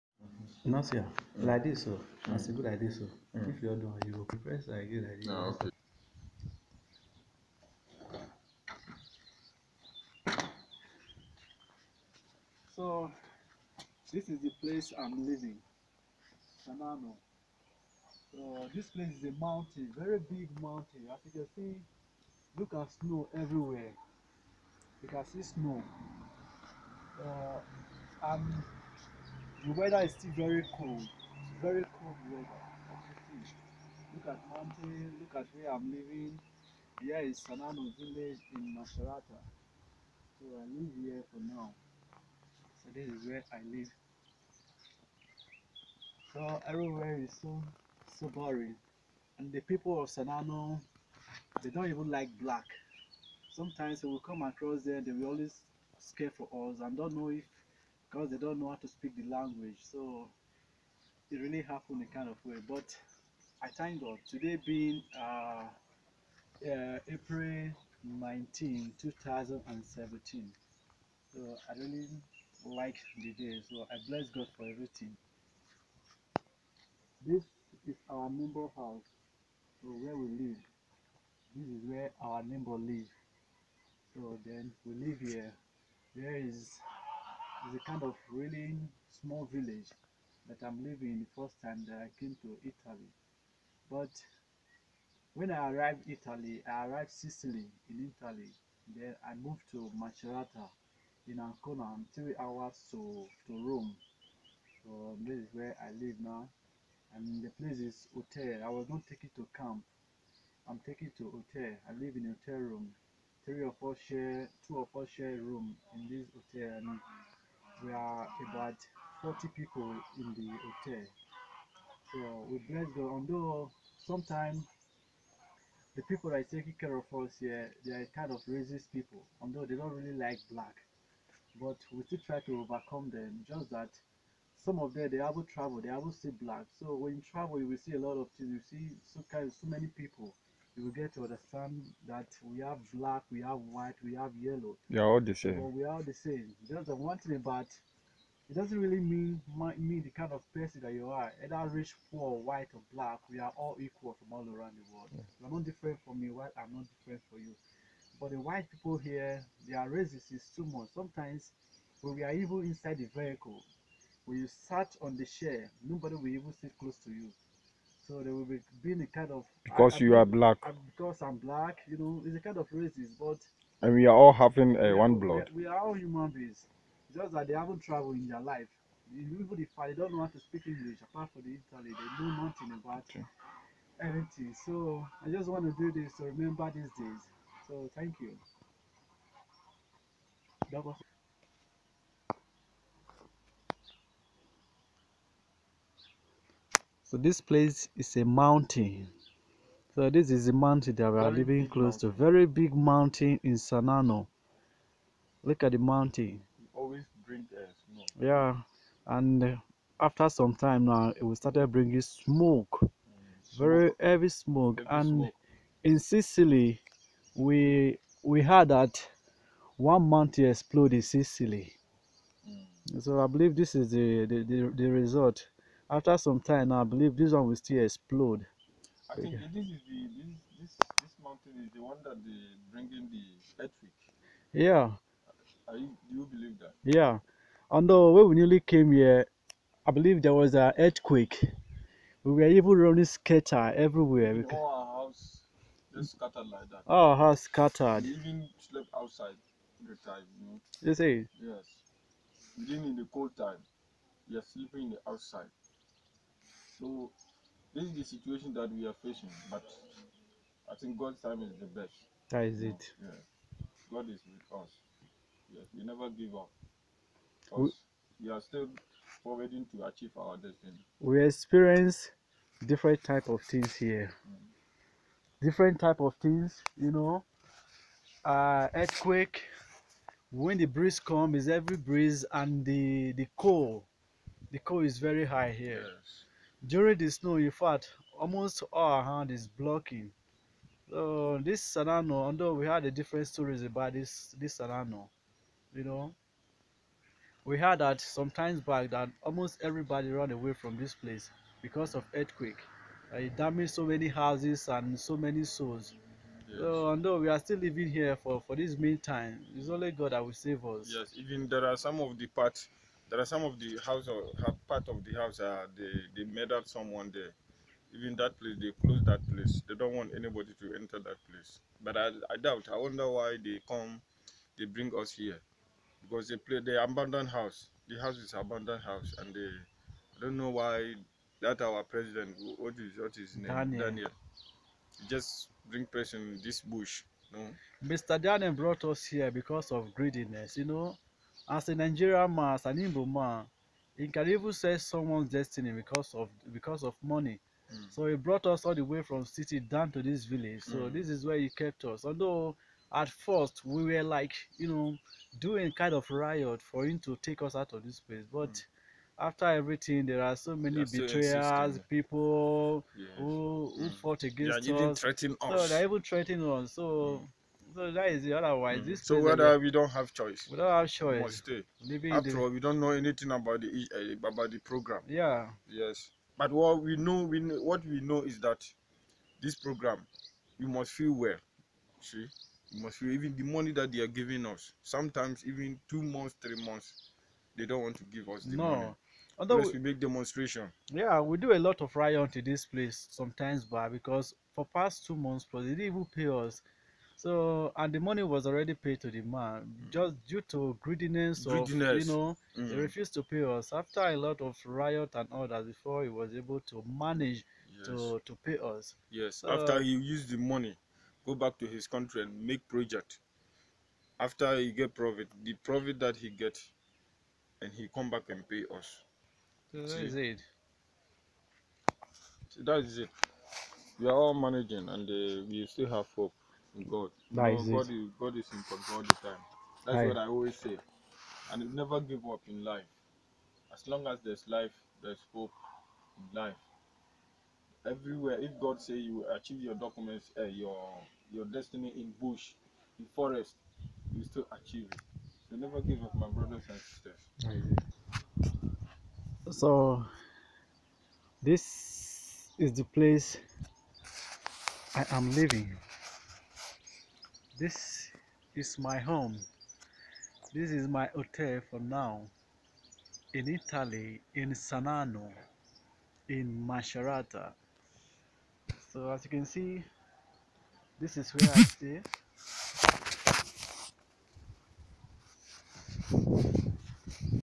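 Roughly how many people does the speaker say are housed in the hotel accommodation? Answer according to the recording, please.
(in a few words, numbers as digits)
40.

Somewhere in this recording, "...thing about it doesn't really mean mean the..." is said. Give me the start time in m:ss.
2:27.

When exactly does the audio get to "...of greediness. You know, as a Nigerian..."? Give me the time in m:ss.
5:39.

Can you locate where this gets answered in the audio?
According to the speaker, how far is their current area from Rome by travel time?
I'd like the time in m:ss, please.
1:42.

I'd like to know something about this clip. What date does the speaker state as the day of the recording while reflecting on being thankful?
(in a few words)
April 19, 2017.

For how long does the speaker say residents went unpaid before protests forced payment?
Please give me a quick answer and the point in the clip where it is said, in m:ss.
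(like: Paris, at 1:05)
2 months plus, at 6:35.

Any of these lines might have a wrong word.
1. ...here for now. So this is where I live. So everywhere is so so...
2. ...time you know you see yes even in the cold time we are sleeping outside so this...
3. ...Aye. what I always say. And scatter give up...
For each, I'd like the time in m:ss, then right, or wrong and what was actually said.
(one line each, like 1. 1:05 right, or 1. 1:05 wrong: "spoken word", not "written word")
1. 0:41 right
2. 4:10 right
3. 7:09 wrong: "never", not "scatter".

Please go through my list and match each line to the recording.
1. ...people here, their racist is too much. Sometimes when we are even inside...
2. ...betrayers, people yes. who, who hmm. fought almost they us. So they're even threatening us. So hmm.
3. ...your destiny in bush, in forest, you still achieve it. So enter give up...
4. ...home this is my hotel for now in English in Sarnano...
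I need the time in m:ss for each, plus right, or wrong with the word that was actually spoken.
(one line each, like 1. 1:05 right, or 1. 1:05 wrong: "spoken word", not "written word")
1. 2:38 right
2. 6:00 wrong: "against", not "almost"
3. 7:21 wrong: "never", not "enter"
4. 7:38 wrong: "Italy", not "English".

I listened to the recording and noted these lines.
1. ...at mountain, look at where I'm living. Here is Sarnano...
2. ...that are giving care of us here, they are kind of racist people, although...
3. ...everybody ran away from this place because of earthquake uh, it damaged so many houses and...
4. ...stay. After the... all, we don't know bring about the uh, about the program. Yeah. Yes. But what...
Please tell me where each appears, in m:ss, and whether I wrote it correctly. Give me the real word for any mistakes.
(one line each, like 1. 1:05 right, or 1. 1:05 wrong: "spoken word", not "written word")
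1. 0:34 right
2. 2:06 wrong: "taking", not "giving"
3. 4:59 right
4. 6:11 wrong: "anything", not "bring".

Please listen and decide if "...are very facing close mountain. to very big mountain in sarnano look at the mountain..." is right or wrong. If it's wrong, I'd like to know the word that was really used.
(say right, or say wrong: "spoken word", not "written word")
wrong: "living", not "facing".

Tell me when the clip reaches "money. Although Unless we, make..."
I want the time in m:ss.
6:28.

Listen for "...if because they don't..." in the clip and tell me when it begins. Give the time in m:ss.
0:57.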